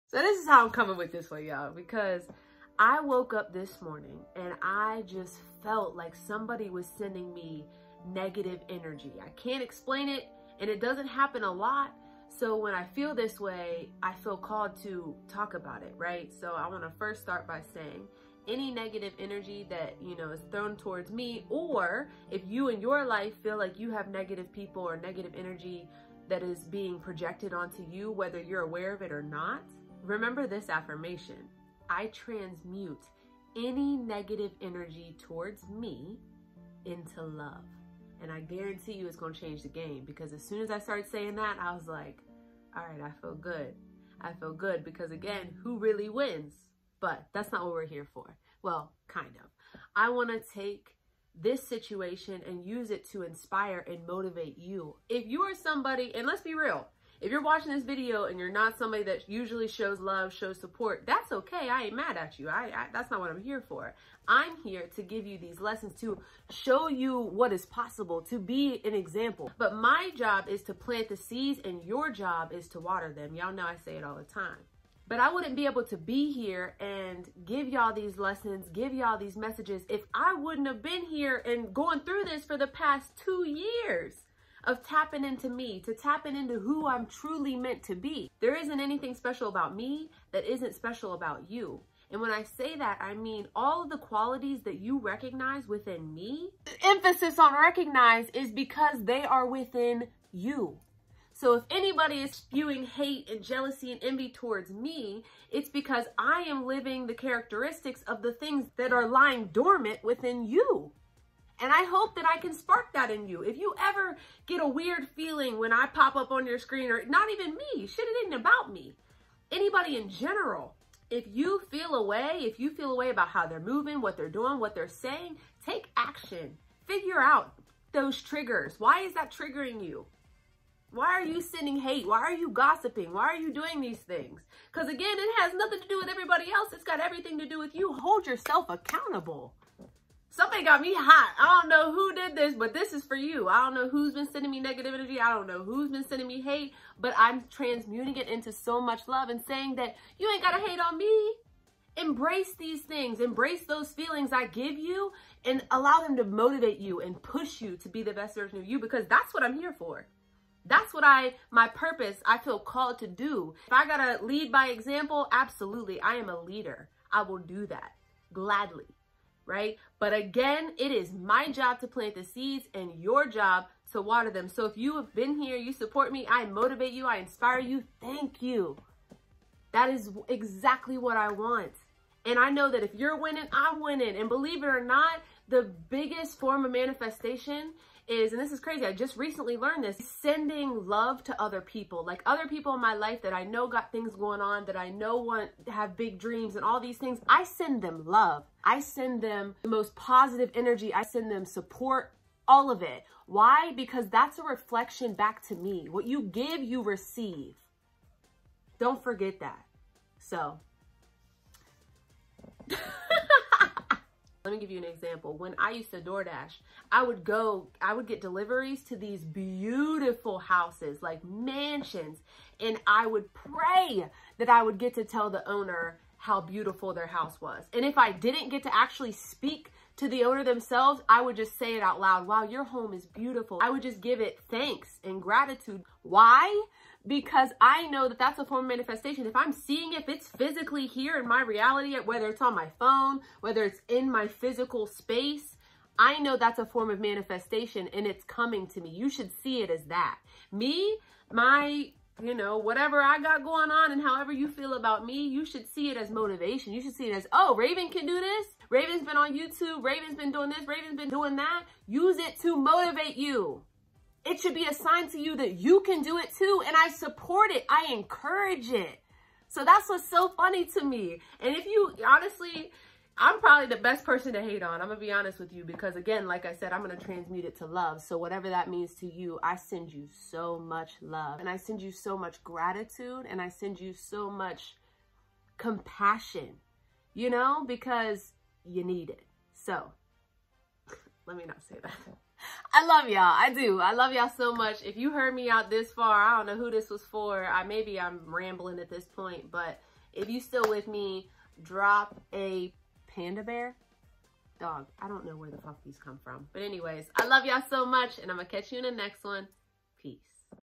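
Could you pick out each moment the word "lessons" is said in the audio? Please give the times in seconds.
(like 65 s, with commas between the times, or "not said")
65 s, 78 s.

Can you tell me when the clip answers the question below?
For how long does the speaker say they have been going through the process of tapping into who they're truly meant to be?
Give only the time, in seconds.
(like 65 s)
83 s.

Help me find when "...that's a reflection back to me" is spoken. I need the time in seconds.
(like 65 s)
204 s.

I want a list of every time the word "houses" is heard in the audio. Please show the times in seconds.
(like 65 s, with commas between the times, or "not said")
220 s, 227 s.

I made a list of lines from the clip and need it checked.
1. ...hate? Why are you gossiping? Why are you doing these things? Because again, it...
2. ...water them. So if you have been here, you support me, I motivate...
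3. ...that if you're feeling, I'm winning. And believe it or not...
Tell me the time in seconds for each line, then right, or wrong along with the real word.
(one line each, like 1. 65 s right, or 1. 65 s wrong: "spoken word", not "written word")
1. 131 s right
2. 174 s right
3. 182 s wrong: "winning", not "feeling".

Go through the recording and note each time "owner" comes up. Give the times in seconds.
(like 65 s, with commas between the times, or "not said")
225 s, 230 s.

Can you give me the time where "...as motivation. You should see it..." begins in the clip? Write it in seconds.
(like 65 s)
255 s.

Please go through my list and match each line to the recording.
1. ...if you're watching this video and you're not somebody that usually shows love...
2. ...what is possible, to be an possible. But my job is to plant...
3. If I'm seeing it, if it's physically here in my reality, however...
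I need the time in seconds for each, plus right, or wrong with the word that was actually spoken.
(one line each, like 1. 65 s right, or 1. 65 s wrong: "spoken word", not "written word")
1. 57 s right
2. 67 s wrong: "example", not "possible"
3. 239 s wrong: "whether", not "however".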